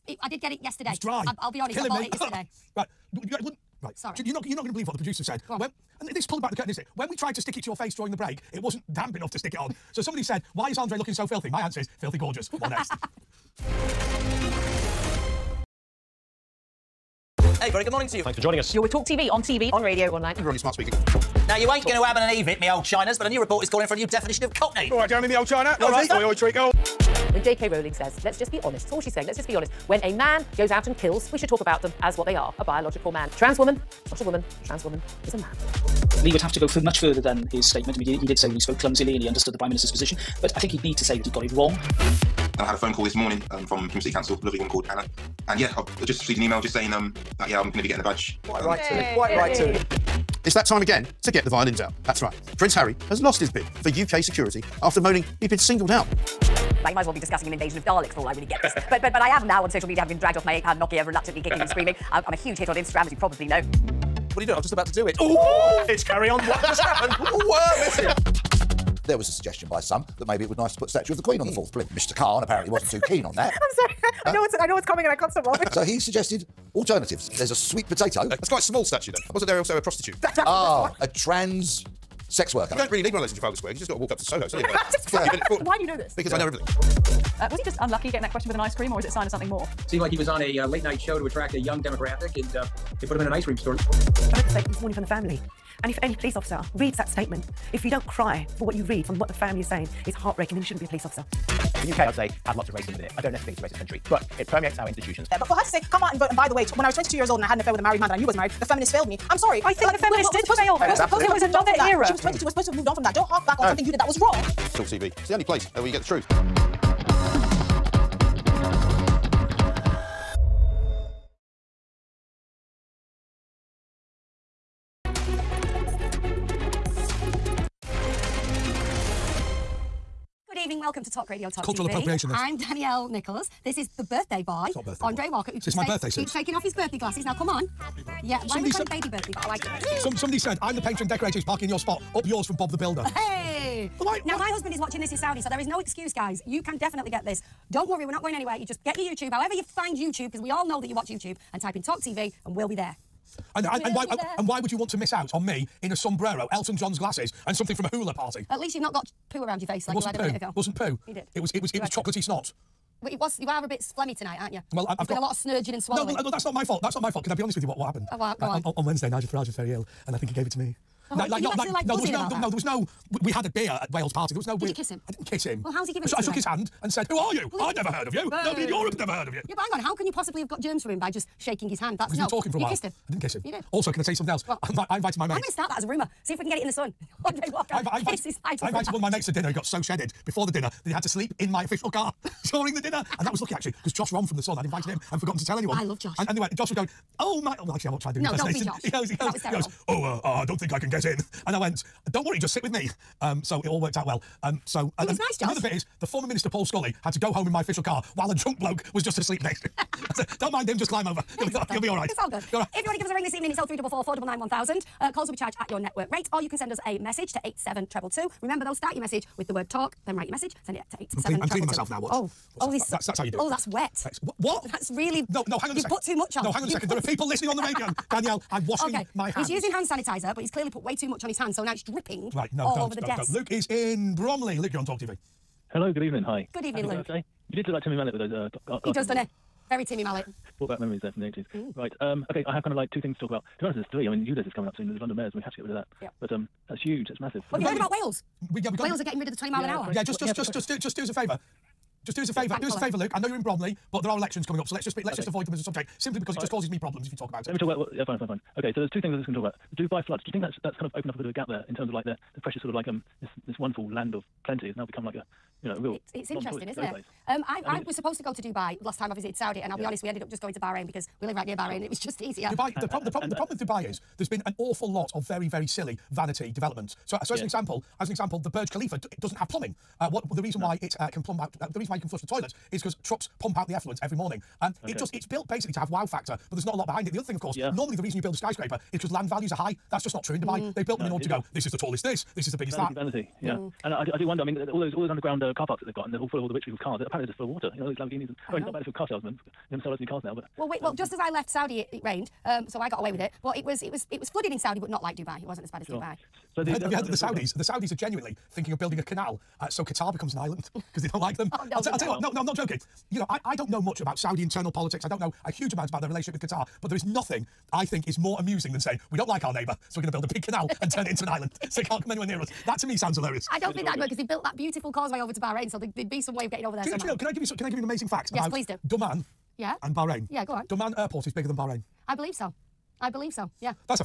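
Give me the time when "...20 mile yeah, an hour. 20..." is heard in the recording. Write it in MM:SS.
04:09.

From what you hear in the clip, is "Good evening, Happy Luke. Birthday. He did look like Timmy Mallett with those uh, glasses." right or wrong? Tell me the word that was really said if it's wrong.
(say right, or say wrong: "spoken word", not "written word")
right.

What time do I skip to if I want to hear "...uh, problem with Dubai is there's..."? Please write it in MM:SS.
04:33.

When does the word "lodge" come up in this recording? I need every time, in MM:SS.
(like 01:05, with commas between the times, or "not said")
not said.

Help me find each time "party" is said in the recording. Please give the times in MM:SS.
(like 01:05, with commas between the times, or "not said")
02:38, 02:54.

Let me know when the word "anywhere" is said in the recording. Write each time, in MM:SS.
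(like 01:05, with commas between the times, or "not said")
02:28, 05:22.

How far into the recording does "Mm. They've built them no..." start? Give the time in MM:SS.
04:50.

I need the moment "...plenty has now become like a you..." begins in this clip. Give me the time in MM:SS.
04:24.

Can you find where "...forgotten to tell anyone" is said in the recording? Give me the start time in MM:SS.
03:15.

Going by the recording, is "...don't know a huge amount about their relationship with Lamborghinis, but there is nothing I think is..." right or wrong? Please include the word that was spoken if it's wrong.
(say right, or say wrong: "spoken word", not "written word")
wrong: "Qatar", not "Lamborghinis".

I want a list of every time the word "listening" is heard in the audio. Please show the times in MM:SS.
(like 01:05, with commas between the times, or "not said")
03:47.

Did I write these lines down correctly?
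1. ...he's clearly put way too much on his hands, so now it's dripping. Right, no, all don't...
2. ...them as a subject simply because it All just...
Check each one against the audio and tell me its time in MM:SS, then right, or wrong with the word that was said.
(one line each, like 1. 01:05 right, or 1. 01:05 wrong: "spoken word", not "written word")
1. 03:50 right
2. 04:15 right.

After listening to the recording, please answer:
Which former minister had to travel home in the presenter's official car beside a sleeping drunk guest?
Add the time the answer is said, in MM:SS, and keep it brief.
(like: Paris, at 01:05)
Paul Scully, at 03:26.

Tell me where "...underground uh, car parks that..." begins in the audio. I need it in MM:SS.
04:55.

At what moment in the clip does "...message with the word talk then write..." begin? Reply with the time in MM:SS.
03:39.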